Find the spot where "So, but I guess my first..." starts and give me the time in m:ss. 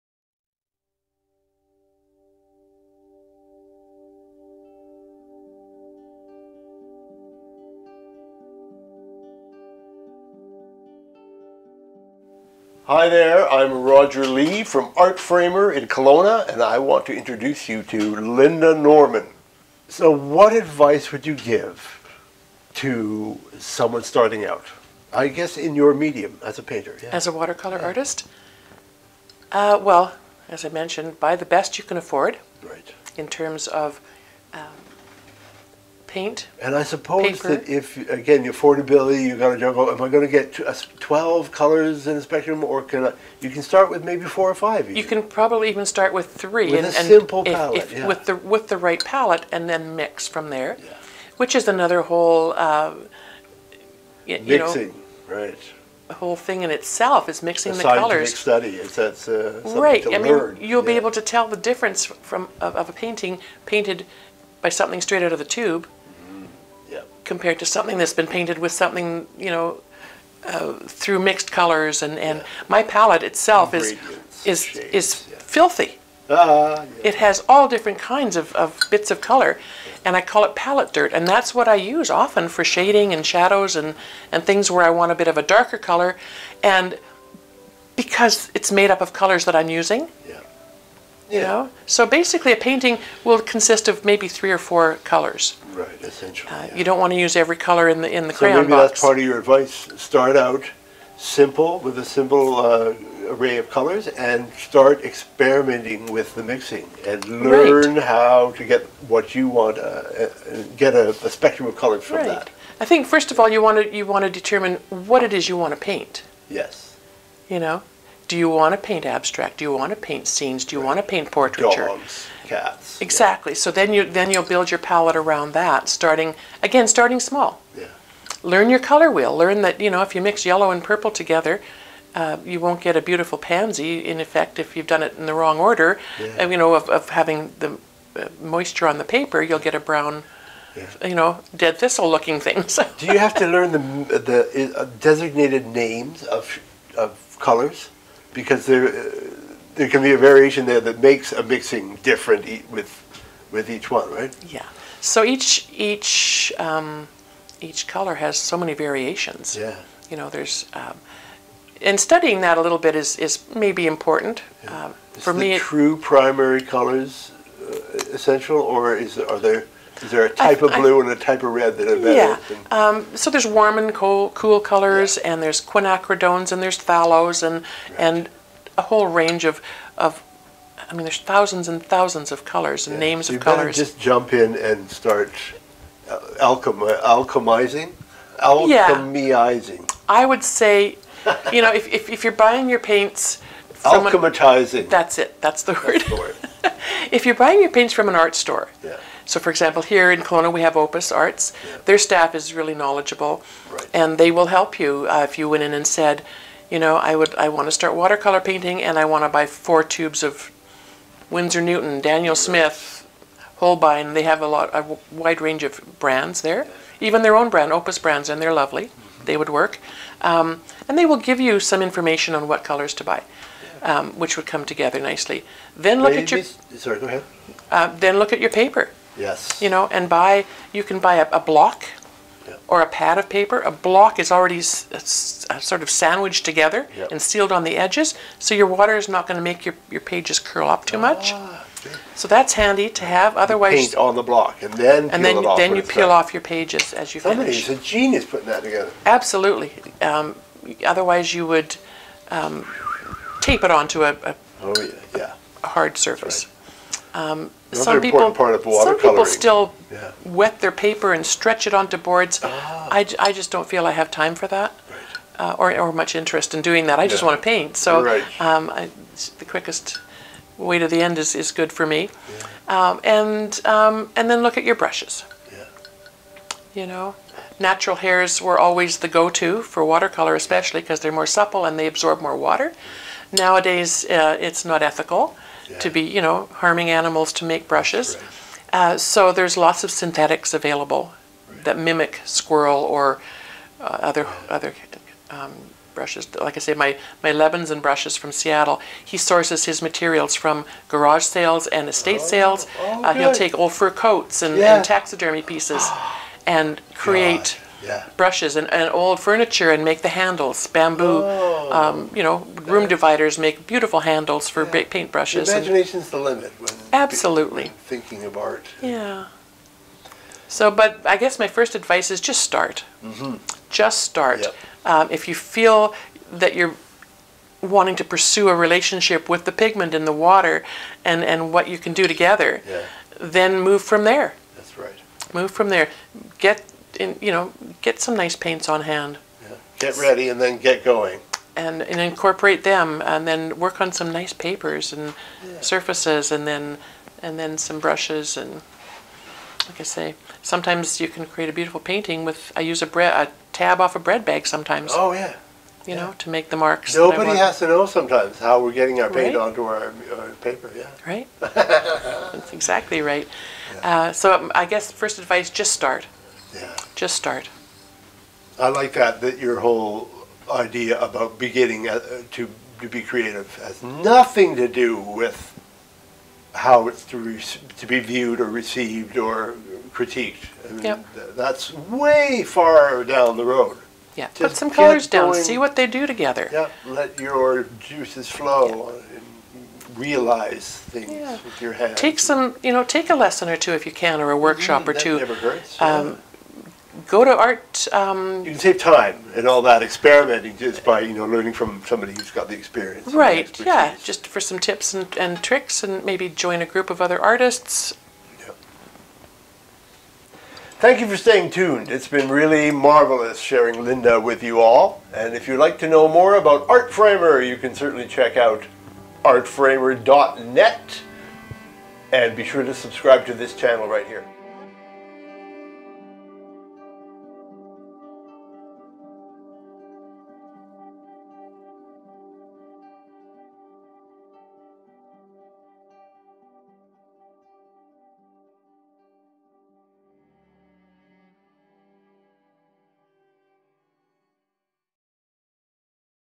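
5:20.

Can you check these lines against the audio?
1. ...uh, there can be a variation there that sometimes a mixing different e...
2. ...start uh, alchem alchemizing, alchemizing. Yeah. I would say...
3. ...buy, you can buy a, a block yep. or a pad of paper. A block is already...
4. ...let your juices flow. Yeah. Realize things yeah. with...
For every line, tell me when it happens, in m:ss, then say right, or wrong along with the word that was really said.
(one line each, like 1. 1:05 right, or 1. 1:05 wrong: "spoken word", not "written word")
1. 2:28 wrong: "makes", not "sometimes"
2. 3:04 right
3. 3:50 right
4. 6:26 right.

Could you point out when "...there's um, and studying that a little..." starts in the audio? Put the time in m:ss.
2:40.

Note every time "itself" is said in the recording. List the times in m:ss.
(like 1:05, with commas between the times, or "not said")
0:56, 1:13.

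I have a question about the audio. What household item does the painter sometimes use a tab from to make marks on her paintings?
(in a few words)
bread bag.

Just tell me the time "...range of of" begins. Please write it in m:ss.
2:59.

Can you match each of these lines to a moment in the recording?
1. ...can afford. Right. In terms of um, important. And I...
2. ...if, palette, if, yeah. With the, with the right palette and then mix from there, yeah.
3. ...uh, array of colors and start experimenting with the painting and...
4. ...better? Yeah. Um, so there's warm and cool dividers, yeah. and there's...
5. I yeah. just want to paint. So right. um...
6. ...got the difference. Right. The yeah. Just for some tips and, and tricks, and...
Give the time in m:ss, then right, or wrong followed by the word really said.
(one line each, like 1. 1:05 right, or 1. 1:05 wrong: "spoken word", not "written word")
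1. 0:31 wrong: "paint", not "important"
2. 0:47 right
3. 1:42 wrong: "mixing", not "painting"
4. 2:51 wrong: "colors", not "dividers"
5. 4:26 right
6. 6:42 wrong: "experience", not "difference".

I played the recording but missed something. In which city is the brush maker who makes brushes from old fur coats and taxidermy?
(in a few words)
Seattle.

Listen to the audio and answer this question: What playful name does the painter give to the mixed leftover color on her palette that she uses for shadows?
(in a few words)
palette dirt.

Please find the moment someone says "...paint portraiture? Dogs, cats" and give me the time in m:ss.
2:01.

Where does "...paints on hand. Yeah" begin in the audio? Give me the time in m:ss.
5:38.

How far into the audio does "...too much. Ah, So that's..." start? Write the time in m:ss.
4:00.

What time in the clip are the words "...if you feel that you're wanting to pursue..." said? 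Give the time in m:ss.
5:25.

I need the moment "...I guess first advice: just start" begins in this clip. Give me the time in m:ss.
6:04.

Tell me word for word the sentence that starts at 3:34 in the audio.
They have a lot a wide range of brands there.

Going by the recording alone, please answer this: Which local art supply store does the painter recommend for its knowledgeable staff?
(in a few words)
Opus Arts.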